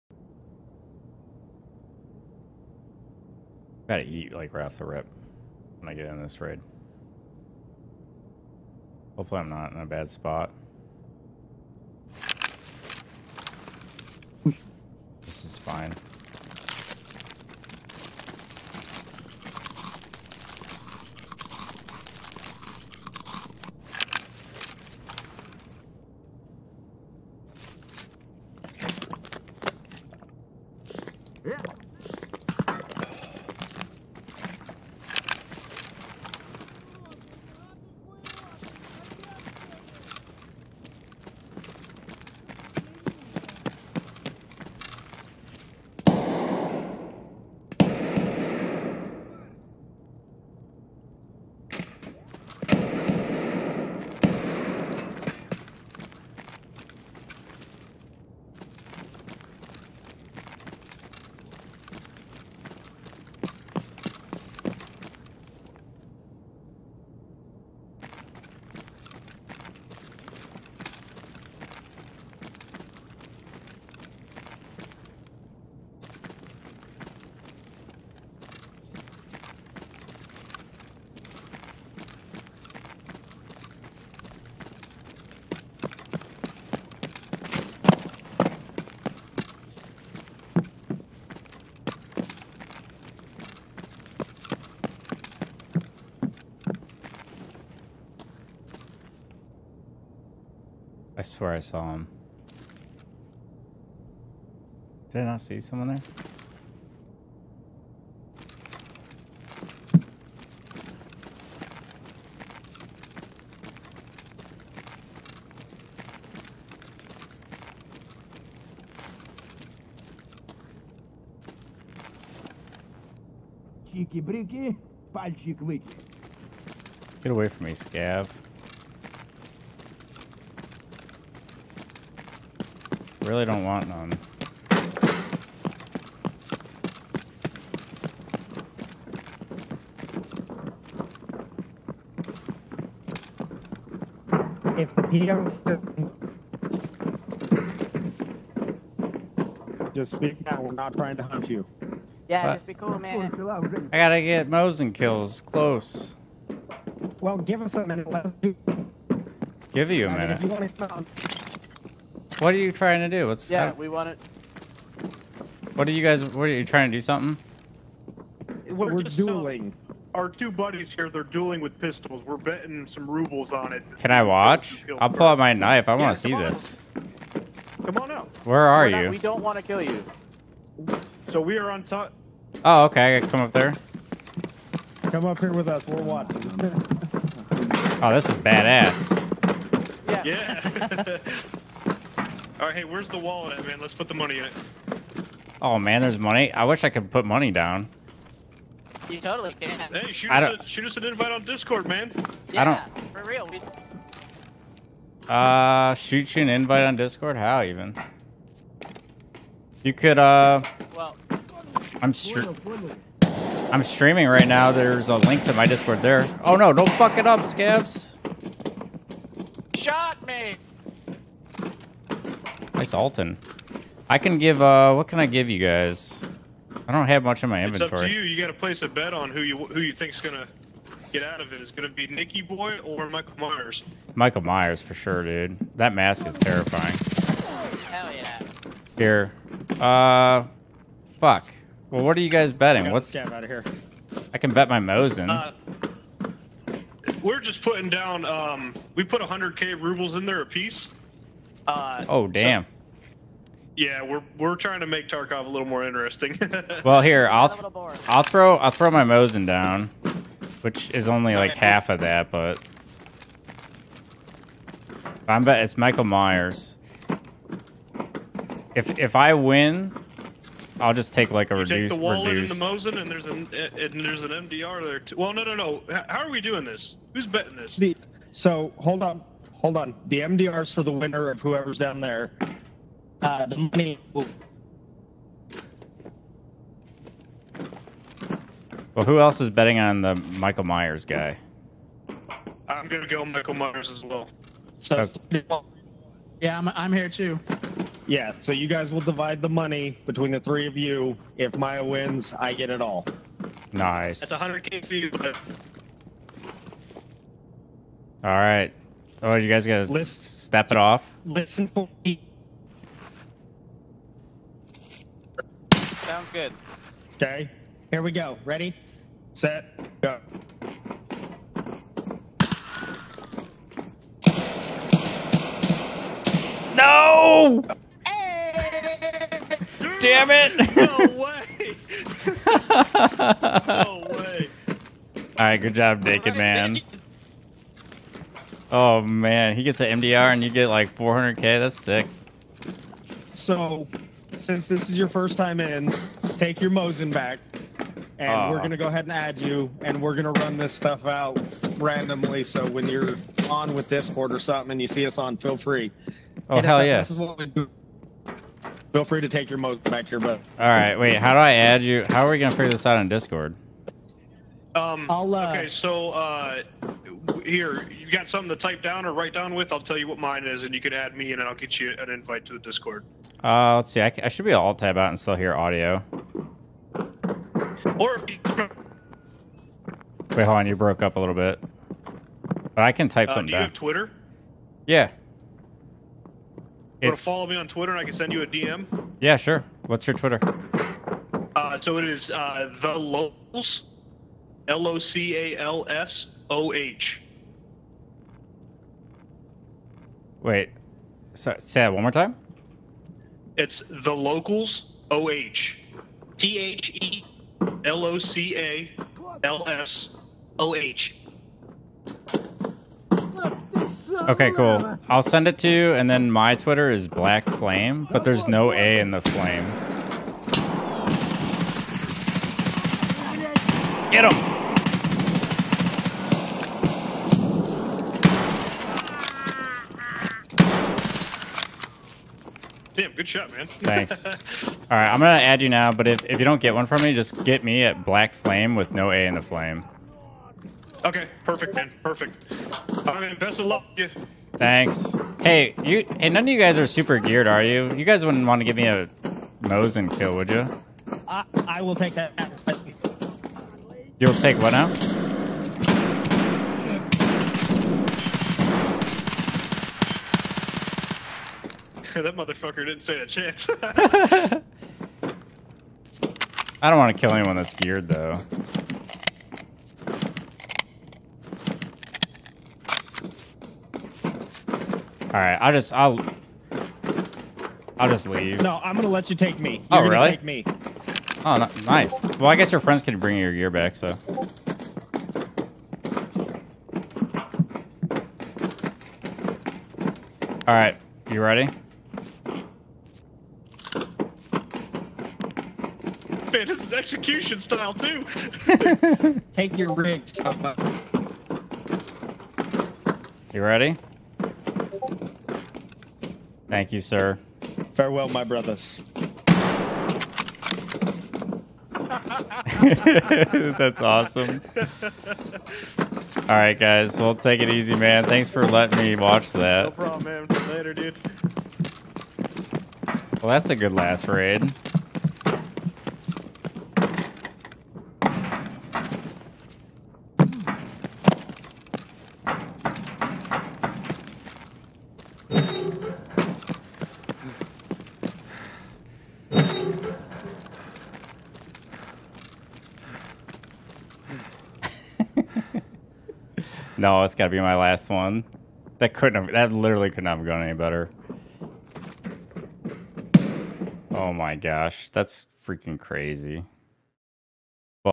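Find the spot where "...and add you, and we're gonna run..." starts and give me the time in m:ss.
5:49.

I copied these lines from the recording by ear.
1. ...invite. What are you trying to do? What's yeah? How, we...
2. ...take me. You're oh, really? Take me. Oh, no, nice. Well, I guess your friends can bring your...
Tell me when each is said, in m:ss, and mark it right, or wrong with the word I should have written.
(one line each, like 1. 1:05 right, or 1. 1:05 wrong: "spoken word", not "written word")
1. 2:40 wrong: "minute", not "invite"
2. 7:59 right.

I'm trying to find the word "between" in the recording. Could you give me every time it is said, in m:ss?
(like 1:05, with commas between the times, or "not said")
5:00.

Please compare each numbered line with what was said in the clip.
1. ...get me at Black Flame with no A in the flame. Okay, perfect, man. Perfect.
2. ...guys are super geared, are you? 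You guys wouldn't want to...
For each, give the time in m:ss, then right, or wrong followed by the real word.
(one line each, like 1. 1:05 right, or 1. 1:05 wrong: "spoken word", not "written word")
1. 7:17 right
2. 7:26 right.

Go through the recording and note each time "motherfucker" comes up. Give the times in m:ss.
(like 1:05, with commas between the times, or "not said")
7:42.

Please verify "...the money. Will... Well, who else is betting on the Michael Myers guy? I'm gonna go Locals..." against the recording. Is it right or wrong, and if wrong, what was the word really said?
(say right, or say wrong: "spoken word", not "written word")
wrong: "Michael", not "Locals".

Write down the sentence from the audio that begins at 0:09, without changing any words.
Hopefully I'm not in a bad spot.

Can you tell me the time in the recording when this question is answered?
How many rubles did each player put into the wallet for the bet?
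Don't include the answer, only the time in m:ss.
4:09.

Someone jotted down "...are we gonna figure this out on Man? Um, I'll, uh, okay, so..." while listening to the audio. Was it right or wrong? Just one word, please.
wrong.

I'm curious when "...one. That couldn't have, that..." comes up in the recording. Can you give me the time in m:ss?
9:08.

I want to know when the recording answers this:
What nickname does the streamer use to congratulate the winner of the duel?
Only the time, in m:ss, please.
5:36.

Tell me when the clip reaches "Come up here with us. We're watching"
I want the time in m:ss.
3:05.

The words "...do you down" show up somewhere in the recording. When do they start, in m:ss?
6:23.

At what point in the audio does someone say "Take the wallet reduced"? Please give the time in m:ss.
4:31.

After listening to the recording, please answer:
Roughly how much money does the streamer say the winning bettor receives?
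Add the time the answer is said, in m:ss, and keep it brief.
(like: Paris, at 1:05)
400k, at 5:40.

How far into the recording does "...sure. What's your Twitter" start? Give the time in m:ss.
6:29.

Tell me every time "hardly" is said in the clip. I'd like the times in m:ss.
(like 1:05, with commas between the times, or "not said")
not said.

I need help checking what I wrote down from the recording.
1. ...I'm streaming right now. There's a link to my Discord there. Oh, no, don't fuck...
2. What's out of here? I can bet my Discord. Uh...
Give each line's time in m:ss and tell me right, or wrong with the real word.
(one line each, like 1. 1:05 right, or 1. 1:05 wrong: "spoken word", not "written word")
1. 3:33 right
2. 4:02 wrong: "Mosin", not "Discord".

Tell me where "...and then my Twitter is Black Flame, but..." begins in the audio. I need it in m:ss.
6:55.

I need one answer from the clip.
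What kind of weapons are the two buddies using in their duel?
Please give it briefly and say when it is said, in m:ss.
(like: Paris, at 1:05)
Pistols, at 2:51.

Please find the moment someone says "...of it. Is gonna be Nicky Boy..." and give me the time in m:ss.
3:51.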